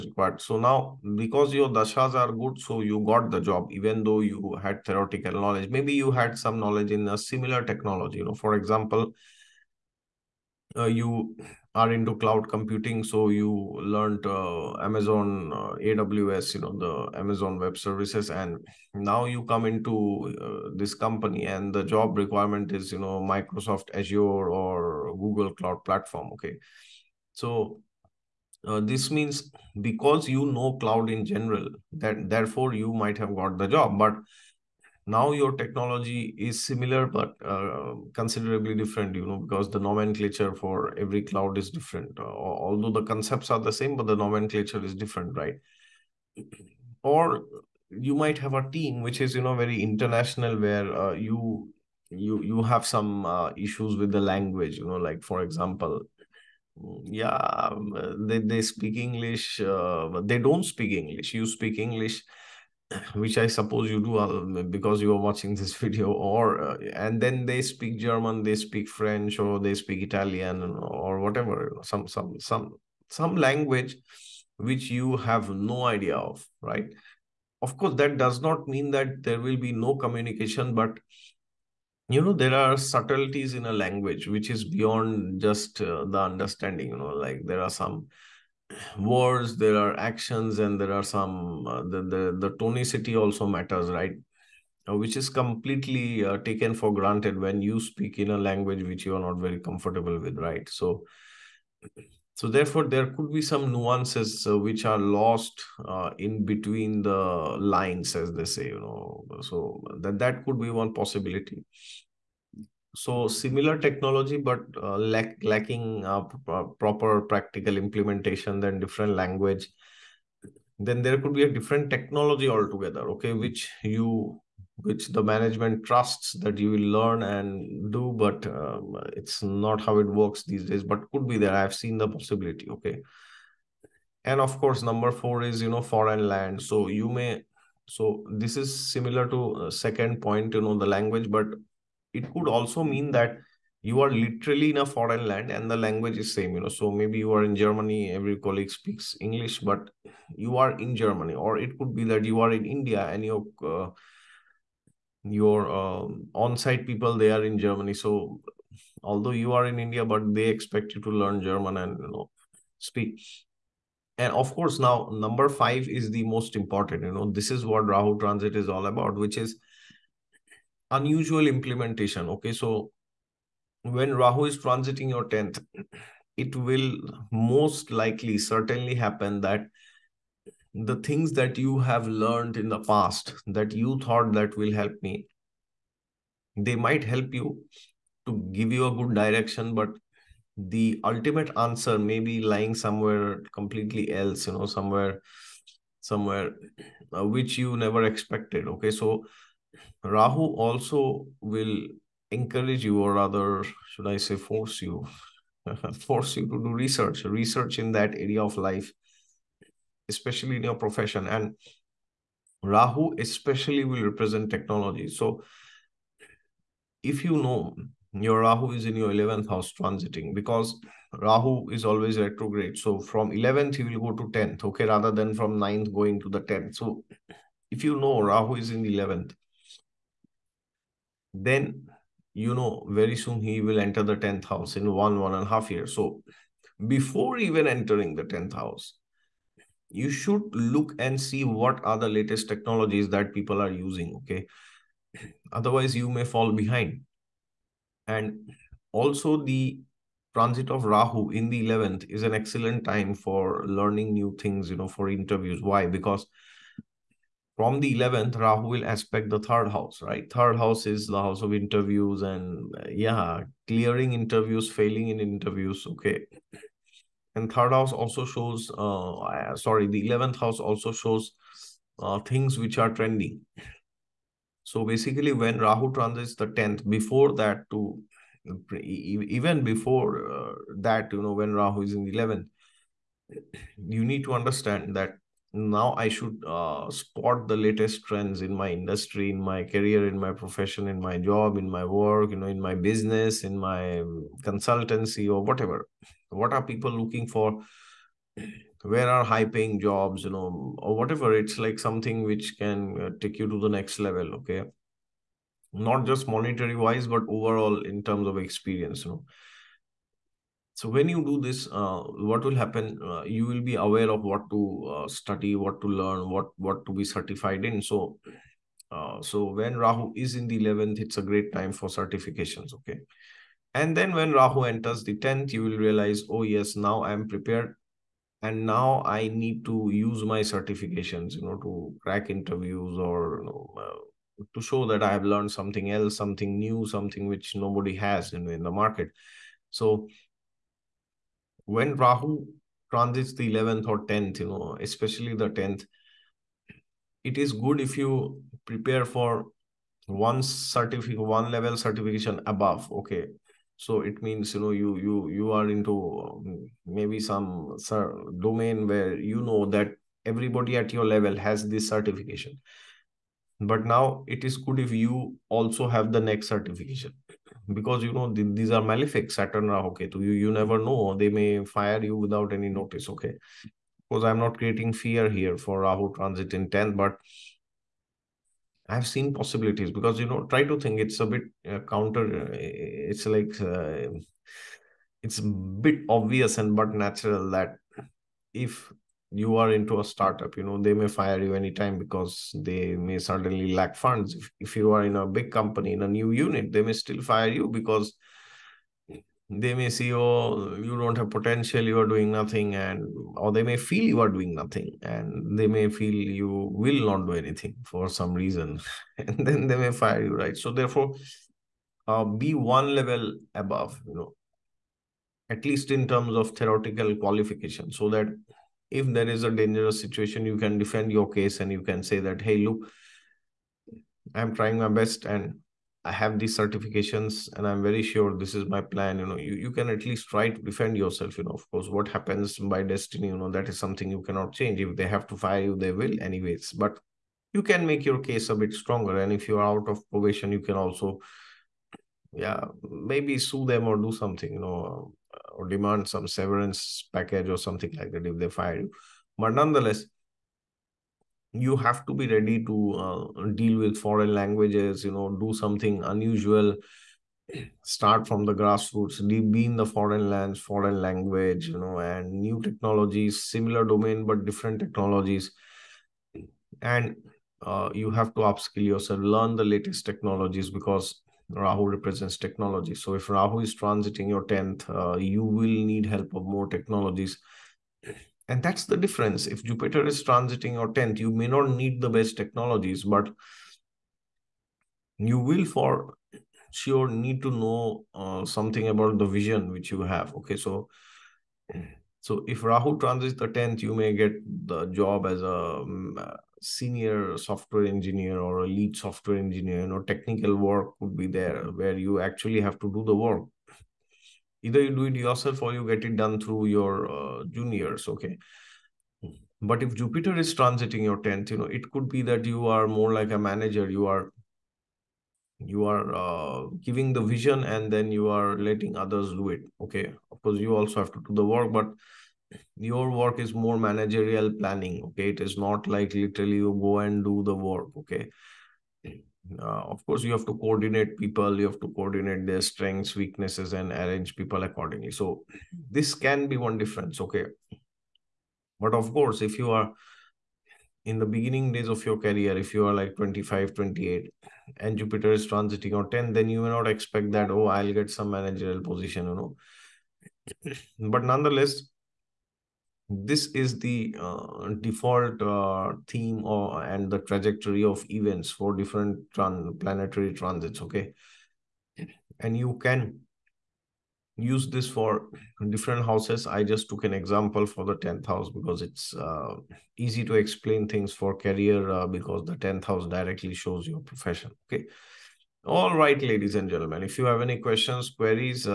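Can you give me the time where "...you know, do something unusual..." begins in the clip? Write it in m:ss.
7:35.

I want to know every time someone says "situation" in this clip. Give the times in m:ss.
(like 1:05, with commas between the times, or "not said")
6:59.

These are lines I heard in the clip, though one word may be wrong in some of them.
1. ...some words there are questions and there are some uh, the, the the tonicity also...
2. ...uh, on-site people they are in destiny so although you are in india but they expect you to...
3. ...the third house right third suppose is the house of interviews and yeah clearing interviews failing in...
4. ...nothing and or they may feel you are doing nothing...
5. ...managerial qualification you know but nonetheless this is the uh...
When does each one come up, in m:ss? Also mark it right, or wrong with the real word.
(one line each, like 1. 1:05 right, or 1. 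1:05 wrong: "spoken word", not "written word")
1. 1:27 wrong: "actions", not "questions"
2. 2:35 wrong: "germany", not "destiny"
3. 4:19 wrong: "house", not "suppose"
4. 6:42 right
5. 9:08 wrong: "position", not "qualification".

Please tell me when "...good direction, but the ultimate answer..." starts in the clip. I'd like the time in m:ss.
3:08.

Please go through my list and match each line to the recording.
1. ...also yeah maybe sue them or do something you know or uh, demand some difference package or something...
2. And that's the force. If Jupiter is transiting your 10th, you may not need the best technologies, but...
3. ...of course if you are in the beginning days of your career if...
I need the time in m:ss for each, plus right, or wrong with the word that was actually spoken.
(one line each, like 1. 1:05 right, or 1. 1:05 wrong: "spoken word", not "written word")
1. 7:20 wrong: "severance", not "difference"
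2. 7:58 wrong: "difference", not "force"
3. 8:58 right.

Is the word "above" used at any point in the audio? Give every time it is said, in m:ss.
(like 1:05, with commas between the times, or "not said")
5:52, 6:53.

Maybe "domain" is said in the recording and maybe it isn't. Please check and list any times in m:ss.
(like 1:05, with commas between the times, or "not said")
5:58, 7:43.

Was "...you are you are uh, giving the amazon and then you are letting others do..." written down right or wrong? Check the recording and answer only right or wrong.
wrong.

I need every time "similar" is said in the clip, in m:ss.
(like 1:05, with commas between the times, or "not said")
0:07, 0:36, 1:53, 2:18, 7:43.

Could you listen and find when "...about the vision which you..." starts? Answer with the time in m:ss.
8:08.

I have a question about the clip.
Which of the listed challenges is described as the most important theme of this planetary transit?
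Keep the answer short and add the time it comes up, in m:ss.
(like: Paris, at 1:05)
unusual implementation, at 2:50.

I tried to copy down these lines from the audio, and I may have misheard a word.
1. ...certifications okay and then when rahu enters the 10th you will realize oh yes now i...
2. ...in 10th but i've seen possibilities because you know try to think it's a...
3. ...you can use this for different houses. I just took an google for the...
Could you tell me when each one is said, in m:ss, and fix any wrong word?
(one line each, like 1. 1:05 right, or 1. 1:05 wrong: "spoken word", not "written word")
1. 5:21 right
2. 6:16 right
3. 9:22 wrong: "example", not "google".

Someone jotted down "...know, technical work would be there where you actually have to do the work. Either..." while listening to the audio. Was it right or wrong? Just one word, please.
right.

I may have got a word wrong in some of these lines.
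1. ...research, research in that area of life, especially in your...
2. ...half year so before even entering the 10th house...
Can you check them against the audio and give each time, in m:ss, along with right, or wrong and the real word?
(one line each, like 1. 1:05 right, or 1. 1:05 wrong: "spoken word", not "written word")
1. 3:26 right
2. 3:55 right.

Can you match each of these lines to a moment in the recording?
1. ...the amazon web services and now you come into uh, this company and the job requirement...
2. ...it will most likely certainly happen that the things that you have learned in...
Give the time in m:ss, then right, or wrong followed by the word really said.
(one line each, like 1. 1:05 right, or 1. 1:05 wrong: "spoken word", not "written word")
1. 0:16 right
2. 2:56 right.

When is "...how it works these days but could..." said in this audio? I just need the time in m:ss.
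2:09.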